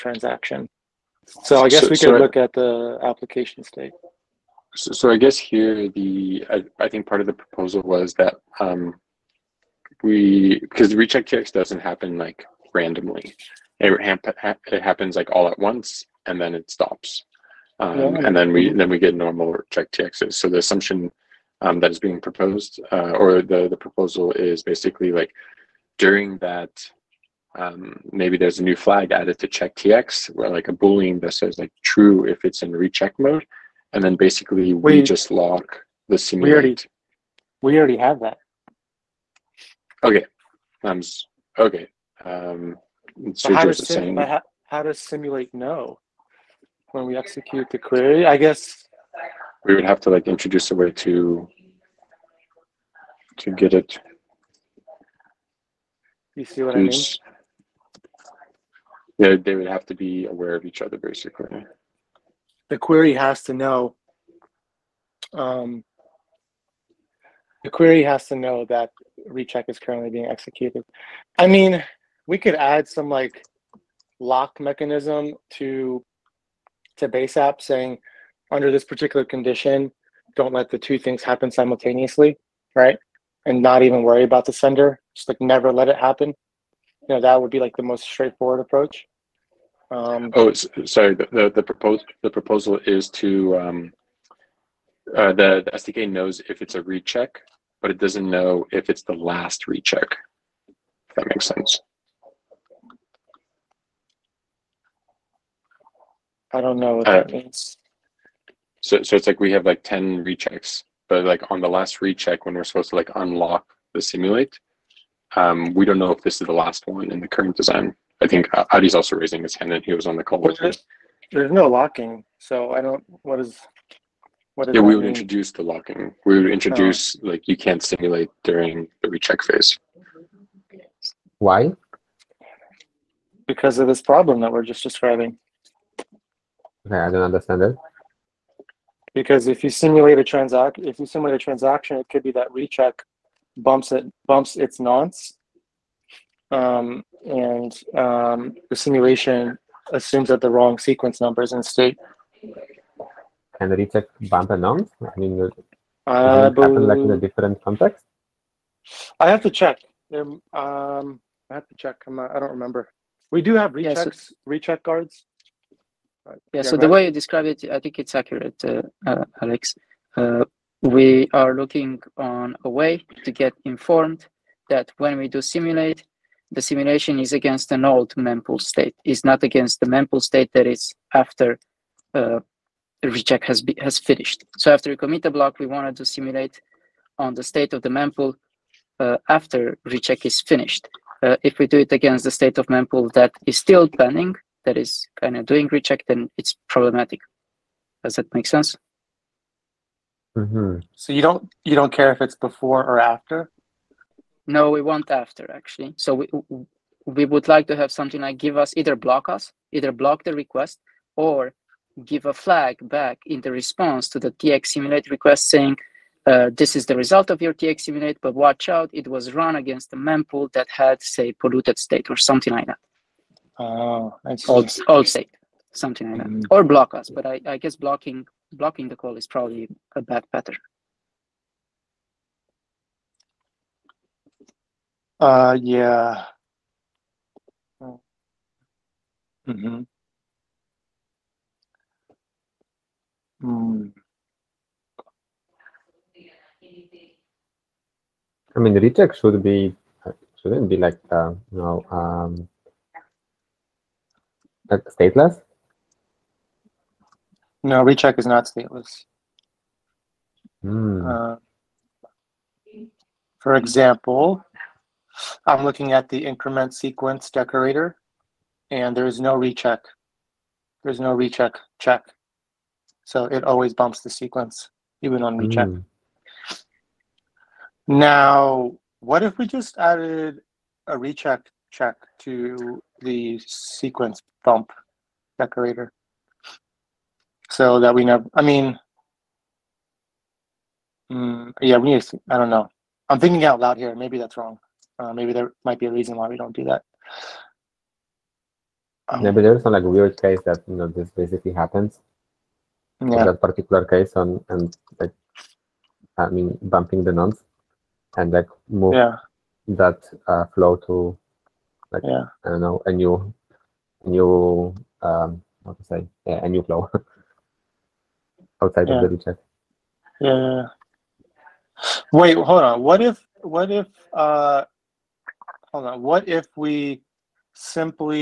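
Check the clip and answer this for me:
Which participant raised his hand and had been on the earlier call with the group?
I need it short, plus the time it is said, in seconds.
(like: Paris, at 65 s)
Adi, at 118 s.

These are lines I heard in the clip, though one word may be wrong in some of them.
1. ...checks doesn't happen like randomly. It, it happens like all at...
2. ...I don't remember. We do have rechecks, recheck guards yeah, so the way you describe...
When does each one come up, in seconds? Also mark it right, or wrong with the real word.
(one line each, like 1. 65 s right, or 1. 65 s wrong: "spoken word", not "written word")
1. 11 s right
2. 162 s right.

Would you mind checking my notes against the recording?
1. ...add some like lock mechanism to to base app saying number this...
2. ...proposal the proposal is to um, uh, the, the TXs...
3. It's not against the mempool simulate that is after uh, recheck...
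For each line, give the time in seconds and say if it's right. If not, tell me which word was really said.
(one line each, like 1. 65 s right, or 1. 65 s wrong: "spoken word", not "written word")
1. 72 s wrong: "under", not "number"
2. 91 s wrong: "SDK", not "TXs"
3. 179 s wrong: "state", not "simulate".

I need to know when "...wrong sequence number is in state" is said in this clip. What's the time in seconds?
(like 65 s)
150 s.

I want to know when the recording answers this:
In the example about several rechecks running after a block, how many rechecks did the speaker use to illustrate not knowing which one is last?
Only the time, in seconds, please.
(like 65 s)
109 s.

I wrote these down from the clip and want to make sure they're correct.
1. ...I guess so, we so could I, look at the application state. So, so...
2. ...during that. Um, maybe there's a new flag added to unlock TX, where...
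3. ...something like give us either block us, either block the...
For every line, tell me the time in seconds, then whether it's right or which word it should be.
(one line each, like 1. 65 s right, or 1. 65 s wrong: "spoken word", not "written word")
1. 1 s right
2. 25 s wrong: "check", not "unlock"
3. 207 s right.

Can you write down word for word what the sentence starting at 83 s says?
And not even worry about the sender, just like never let it happen.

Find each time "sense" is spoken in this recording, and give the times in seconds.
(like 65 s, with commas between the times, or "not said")
101 s, 198 s.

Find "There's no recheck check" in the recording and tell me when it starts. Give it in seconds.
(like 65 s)
270 s.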